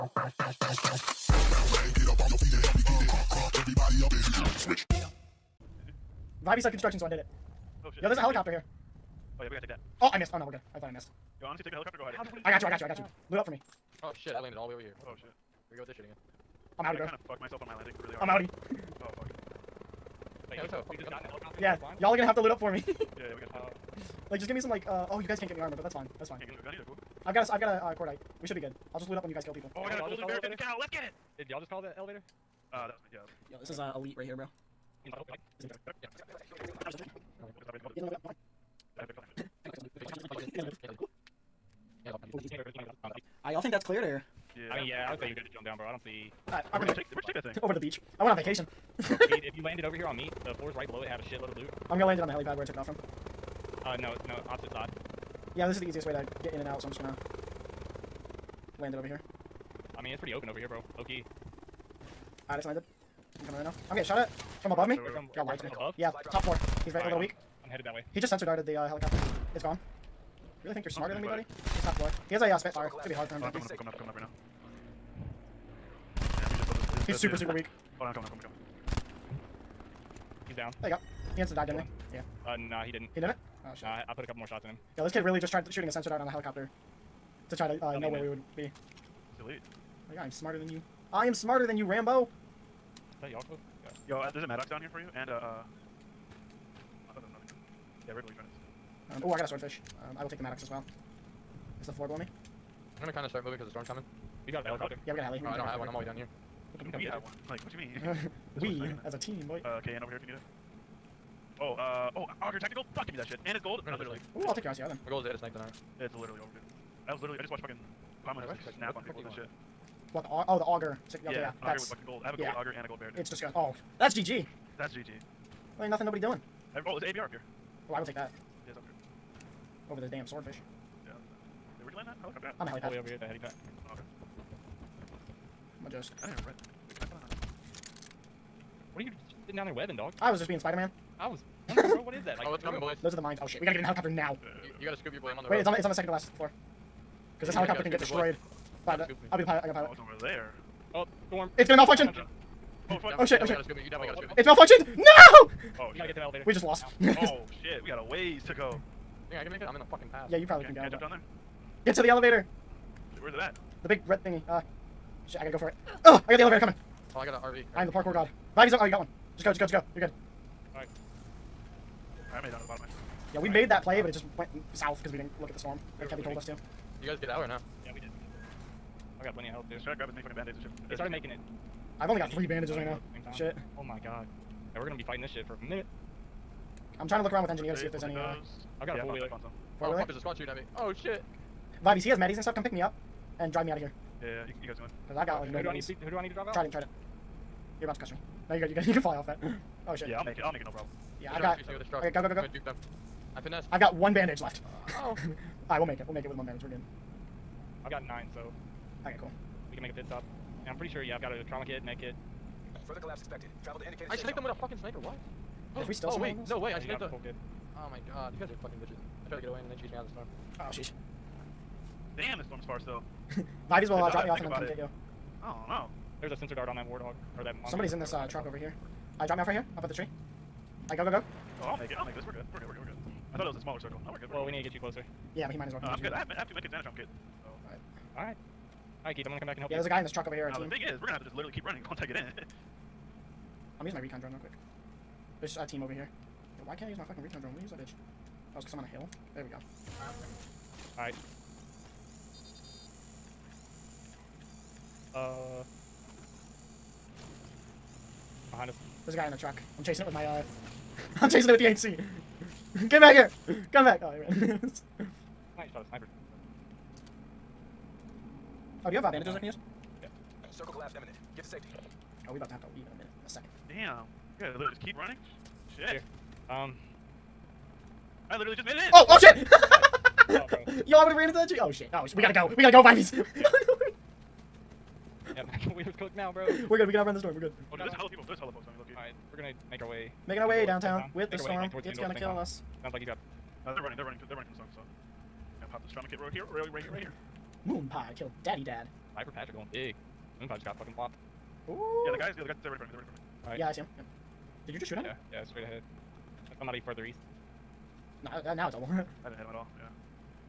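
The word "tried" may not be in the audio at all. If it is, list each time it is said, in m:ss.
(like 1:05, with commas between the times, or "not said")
1:25, 3:39.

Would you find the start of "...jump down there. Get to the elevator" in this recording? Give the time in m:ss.
2:40.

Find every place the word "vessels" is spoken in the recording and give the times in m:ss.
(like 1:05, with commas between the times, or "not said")
not said.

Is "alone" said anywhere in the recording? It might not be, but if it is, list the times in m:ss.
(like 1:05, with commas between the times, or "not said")
not said.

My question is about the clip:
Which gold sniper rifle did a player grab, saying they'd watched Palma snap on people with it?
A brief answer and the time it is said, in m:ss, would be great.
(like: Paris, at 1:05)
Auger Tactical, at 1:52.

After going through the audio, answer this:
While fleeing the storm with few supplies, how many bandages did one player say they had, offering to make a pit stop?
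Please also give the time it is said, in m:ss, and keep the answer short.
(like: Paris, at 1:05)
9, at 3:28.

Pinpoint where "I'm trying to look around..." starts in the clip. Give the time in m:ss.
3:06.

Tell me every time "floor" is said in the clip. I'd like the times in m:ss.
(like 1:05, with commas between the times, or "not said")
0:50, 1:11, 1:41, 2:26.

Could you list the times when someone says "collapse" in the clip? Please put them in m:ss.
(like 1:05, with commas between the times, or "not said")
3:32, 4:30.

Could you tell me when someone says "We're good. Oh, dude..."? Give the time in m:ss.
4:47.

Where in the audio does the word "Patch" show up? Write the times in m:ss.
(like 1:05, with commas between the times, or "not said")
4:59.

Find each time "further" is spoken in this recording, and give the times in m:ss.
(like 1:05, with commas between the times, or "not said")
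3:32, 5:06.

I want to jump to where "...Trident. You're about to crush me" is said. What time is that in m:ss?
3:16.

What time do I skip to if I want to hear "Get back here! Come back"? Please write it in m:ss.
4:22.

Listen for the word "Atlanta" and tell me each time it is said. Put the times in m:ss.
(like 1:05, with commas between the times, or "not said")
not said.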